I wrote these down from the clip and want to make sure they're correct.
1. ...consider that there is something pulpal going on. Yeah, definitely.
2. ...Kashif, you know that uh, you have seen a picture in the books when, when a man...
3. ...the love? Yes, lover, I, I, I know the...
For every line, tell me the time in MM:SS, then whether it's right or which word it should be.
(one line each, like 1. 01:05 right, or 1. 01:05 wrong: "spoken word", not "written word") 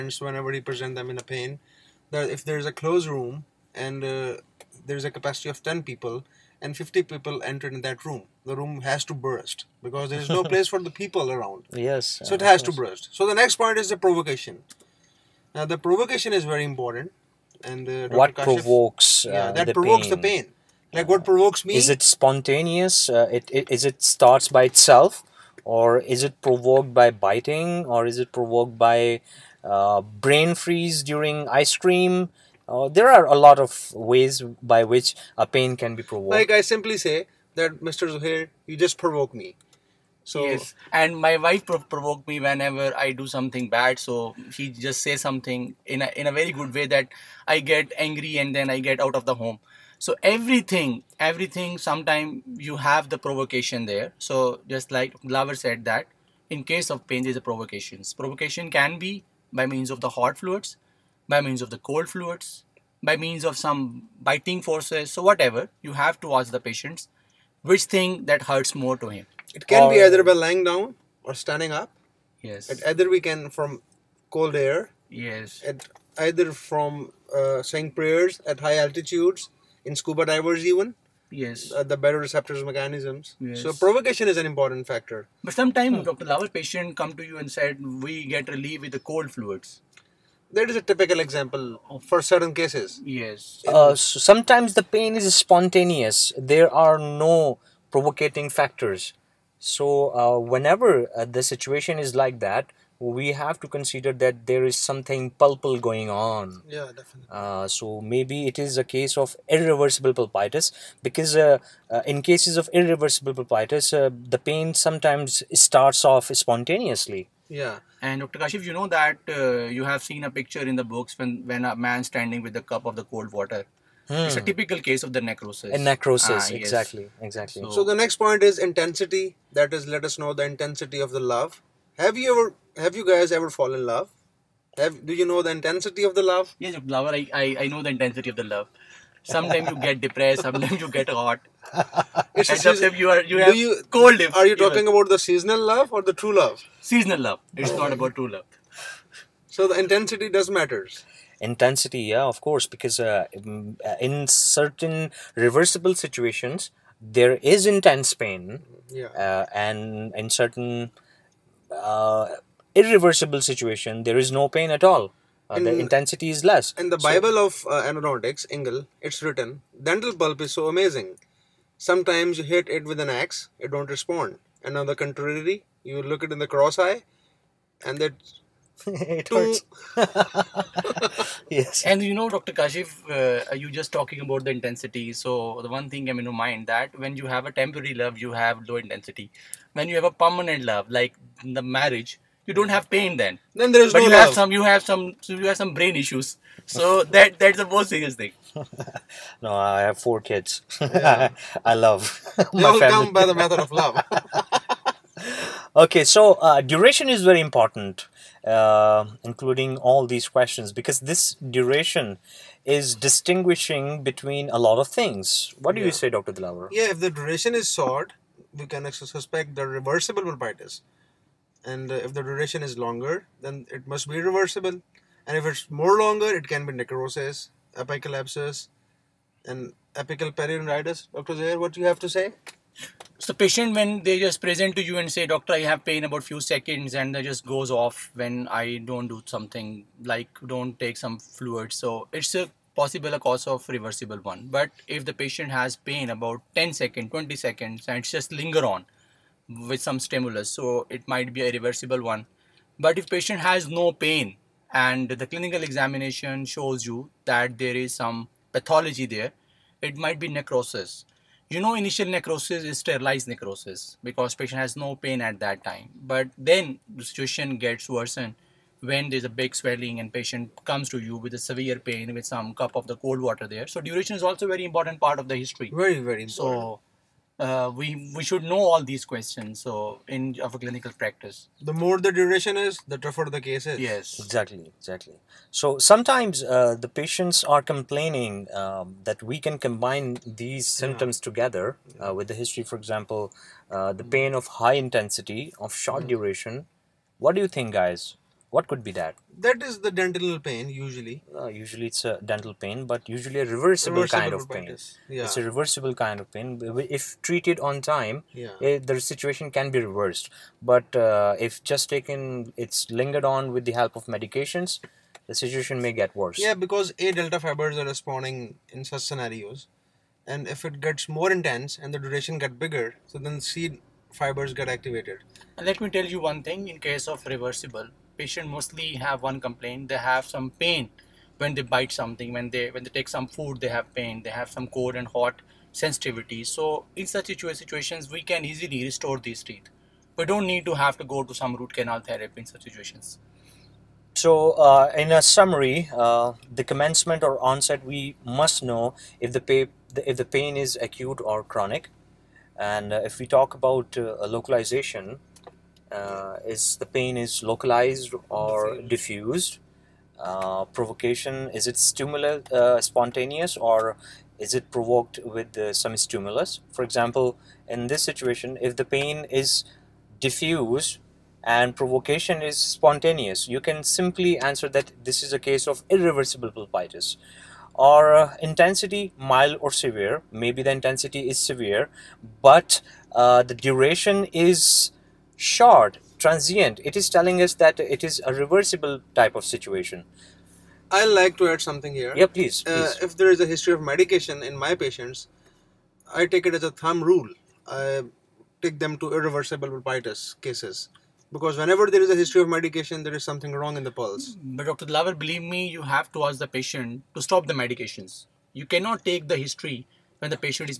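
1. 01:43 right
2. 01:58 right
3. 02:16 right.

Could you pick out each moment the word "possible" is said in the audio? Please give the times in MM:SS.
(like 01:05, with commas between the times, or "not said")
04:02.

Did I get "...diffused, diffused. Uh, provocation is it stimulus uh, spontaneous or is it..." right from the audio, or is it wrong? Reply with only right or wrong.
right.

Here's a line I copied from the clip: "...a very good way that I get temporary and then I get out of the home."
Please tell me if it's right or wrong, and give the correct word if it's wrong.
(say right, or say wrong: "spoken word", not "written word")
wrong: "angry", not "temporary".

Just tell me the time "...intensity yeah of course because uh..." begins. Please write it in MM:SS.
02:31.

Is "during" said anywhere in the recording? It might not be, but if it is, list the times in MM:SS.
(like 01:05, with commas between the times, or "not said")
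00:31.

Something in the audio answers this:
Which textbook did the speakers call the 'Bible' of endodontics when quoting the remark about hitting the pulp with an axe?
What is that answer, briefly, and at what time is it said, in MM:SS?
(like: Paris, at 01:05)
Ingle, at 02:48.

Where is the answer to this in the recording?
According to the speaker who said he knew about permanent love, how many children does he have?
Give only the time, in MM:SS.
03:19.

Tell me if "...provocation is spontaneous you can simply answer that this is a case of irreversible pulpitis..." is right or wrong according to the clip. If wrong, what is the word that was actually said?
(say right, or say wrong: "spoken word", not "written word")
right.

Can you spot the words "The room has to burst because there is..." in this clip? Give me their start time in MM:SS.
00:08.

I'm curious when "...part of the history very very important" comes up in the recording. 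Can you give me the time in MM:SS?
04:34.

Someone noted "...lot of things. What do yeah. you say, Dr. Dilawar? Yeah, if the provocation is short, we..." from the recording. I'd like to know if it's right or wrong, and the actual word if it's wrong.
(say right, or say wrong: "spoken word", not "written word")
wrong: "duration", not "provocation".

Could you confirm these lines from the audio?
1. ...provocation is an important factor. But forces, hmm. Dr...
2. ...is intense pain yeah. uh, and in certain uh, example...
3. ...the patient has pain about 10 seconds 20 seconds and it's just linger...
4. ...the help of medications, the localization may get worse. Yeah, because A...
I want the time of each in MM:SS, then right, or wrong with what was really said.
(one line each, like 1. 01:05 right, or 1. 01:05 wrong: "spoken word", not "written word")
1. 01:23 wrong: "sometimes", not "forces"
2. 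02:37 wrong: "irreversible", not "example"
3. 04:05 right
4. 05:13 wrong: "situation", not "localization".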